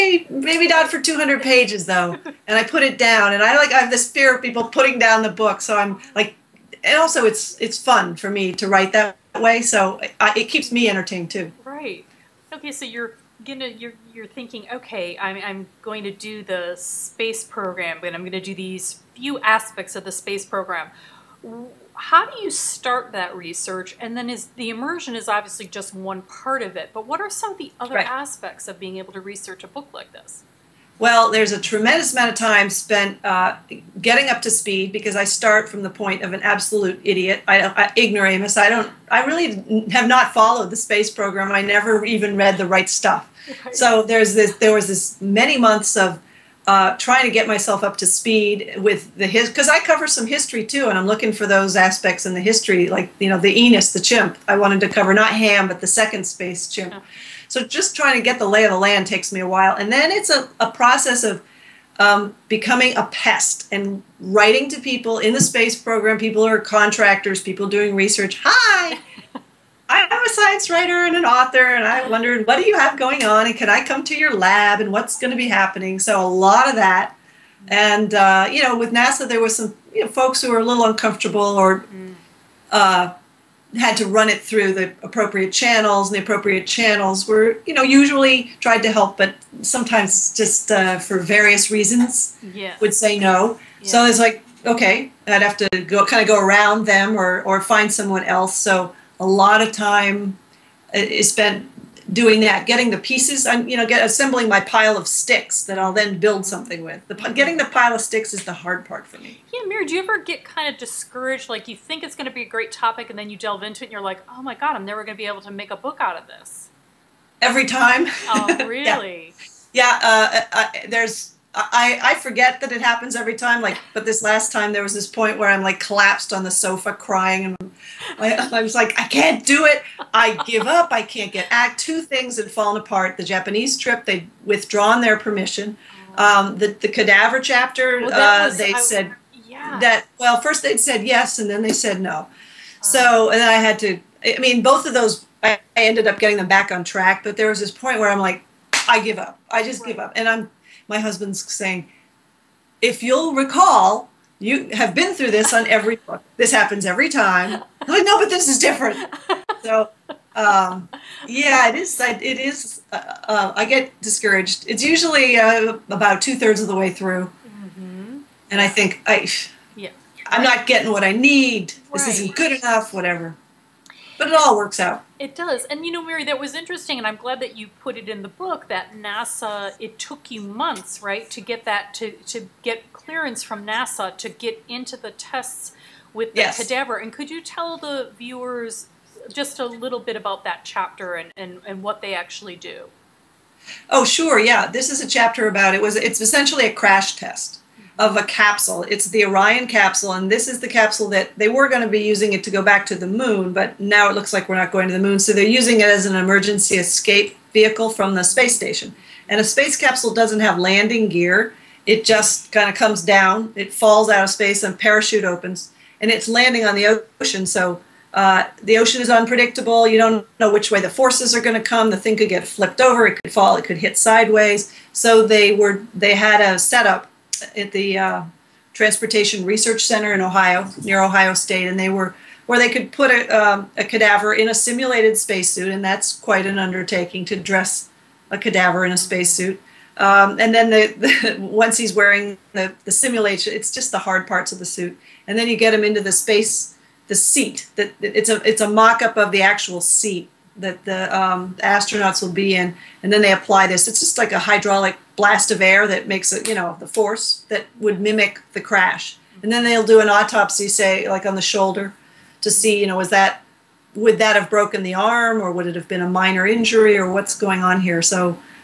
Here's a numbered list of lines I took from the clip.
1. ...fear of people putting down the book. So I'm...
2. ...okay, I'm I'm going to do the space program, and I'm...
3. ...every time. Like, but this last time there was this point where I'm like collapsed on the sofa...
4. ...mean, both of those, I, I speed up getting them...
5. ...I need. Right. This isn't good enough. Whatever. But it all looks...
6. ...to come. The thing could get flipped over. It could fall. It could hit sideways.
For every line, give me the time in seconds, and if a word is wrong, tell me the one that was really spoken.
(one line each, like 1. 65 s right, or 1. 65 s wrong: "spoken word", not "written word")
1. 4 s right
2. 14 s right
3. 123 s right
4. 144 s wrong: "ended", not "speed"
5. 171 s wrong: "works", not "looks"
6. 221 s right.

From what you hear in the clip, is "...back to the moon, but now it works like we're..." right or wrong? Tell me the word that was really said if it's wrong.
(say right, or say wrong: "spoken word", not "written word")
wrong: "looks", not "works".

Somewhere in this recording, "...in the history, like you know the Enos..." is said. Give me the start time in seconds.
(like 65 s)
52 s.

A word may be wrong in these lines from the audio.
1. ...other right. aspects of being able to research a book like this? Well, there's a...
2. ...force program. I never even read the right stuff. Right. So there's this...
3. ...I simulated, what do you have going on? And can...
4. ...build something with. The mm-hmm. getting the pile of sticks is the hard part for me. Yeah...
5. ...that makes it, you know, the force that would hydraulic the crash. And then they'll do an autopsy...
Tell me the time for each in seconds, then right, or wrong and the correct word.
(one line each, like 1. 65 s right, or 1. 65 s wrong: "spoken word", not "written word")
1. 27 s right
2. 40 s wrong: "space", not "force"
3. 71 s wrong: "wondered", not "simulated"
4. 106 s right
5. 255 s wrong: "mimic", not "hydraulic".